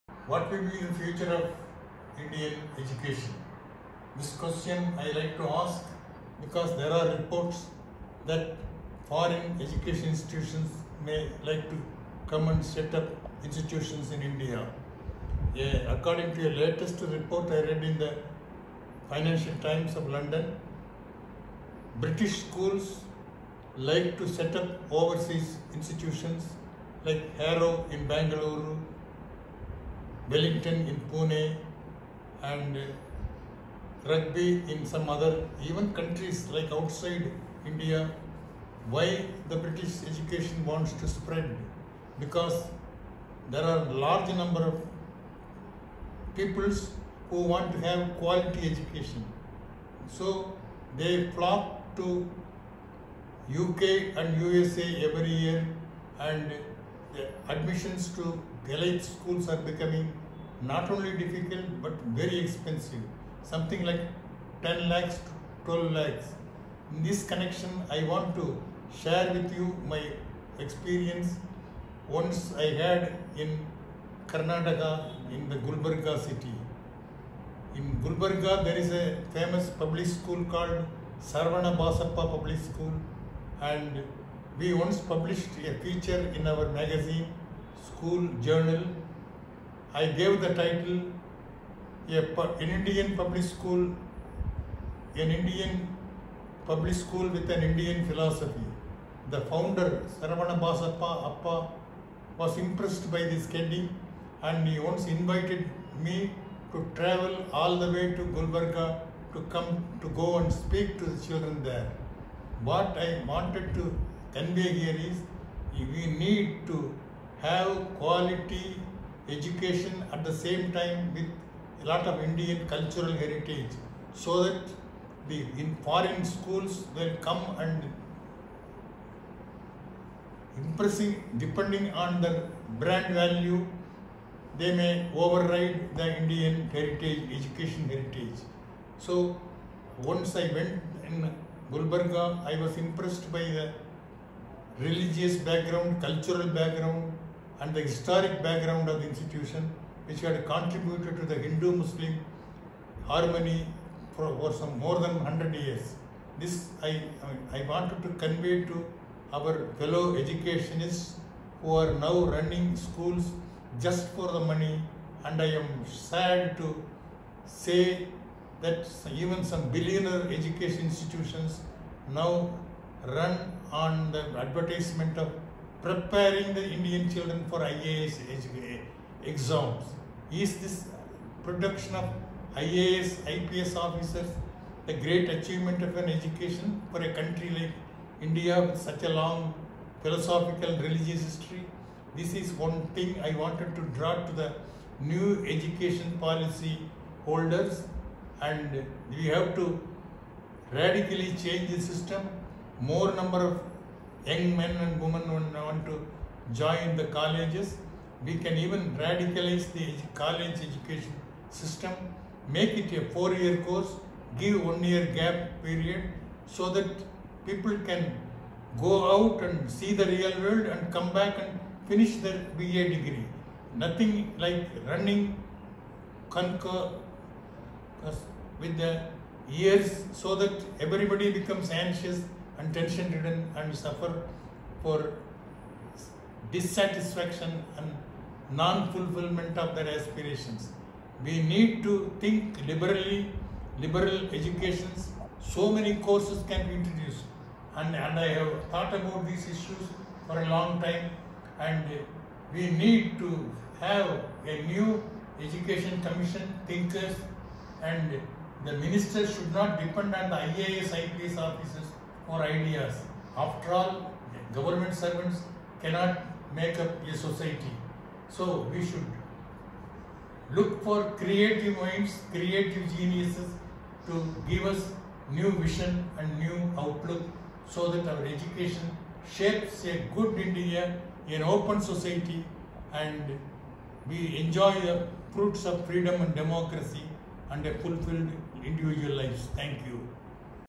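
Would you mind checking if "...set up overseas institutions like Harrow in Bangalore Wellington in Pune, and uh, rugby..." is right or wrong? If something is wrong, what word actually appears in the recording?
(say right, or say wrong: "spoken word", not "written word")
right.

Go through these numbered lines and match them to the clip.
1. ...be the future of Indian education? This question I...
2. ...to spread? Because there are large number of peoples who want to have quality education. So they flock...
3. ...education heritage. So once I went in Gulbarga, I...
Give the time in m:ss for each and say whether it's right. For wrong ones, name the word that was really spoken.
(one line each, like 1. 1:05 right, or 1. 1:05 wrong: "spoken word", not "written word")
1. 0:00 right
2. 0:40 right
3. 2:17 right.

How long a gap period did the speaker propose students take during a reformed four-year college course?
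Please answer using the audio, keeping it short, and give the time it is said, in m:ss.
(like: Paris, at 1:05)
1 year, at 3:34.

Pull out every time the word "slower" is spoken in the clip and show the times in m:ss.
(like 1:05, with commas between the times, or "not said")
not said.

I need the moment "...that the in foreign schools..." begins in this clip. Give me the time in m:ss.
2:04.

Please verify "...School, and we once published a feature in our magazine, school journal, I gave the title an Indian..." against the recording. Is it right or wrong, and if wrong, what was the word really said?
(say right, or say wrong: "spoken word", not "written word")
right.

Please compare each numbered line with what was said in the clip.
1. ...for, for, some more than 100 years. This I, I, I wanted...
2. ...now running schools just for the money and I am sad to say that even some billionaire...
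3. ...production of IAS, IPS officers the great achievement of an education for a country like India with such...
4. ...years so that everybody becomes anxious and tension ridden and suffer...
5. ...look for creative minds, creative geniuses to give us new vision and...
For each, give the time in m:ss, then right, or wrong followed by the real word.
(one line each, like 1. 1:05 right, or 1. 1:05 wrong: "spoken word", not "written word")
1. 2:34 right
2. 2:41 right
3. 3:01 right
4. 3:49 right
5. 4:30 right.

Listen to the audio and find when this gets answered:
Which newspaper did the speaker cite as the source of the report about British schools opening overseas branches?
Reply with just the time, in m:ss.
0:19.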